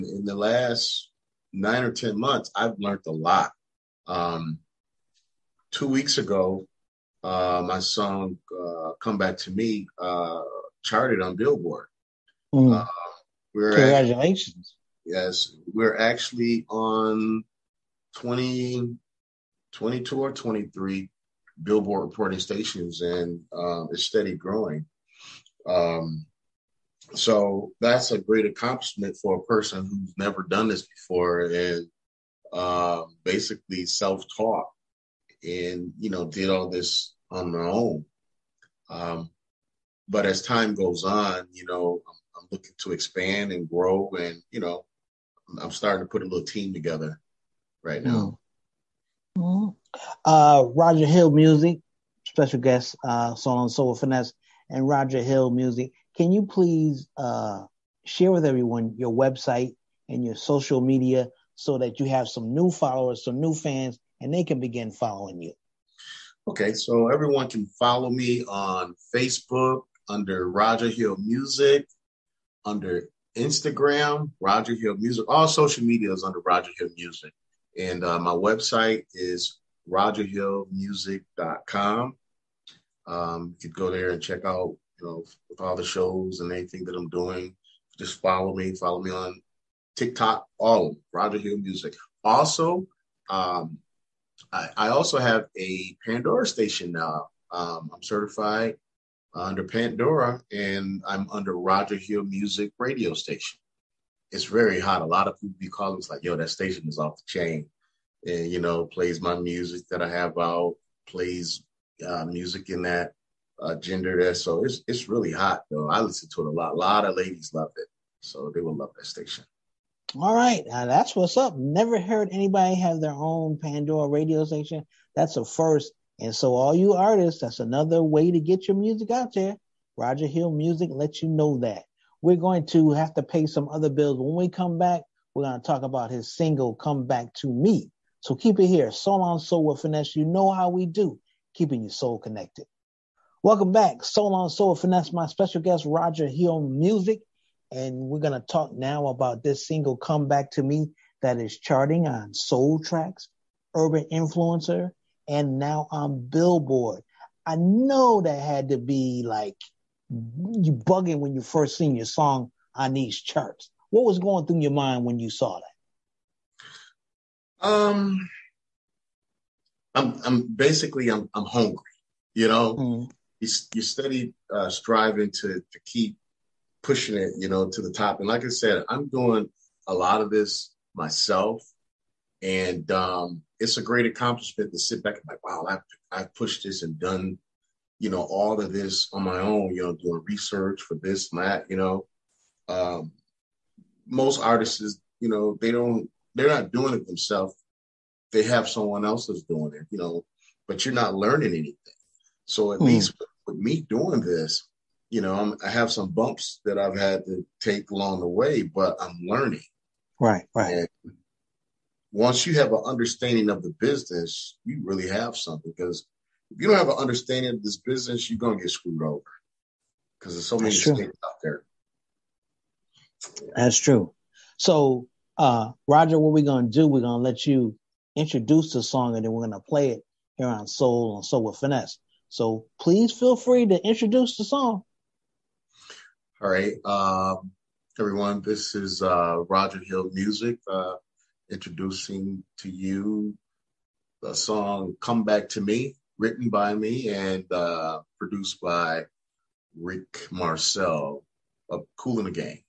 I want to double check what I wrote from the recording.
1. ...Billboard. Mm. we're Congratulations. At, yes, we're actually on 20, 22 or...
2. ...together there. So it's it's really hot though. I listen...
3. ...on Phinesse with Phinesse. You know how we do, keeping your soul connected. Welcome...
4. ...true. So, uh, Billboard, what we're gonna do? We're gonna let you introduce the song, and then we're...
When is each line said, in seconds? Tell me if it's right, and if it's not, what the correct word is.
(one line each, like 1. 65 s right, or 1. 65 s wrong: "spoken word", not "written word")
1. 11 s right
2. 113 s wrong: "gender", not "together"
3. 139 s wrong: "Soul", not "Phinesse"
4. 223 s wrong: "Roger", not "Billboard".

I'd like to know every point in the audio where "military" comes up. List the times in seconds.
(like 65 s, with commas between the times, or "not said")
not said.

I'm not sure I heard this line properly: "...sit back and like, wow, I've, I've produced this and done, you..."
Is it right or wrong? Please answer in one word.
wrong.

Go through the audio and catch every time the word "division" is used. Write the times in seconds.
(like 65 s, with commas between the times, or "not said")
not said.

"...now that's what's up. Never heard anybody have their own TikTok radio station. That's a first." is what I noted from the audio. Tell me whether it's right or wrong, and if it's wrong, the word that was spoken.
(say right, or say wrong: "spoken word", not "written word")
wrong: "Pandora", not "TikTok".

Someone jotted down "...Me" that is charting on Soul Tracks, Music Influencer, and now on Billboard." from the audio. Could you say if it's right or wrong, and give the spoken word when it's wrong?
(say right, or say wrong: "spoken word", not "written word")
wrong: "Urban", not "Music".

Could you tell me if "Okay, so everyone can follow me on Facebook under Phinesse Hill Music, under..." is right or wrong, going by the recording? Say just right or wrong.
wrong.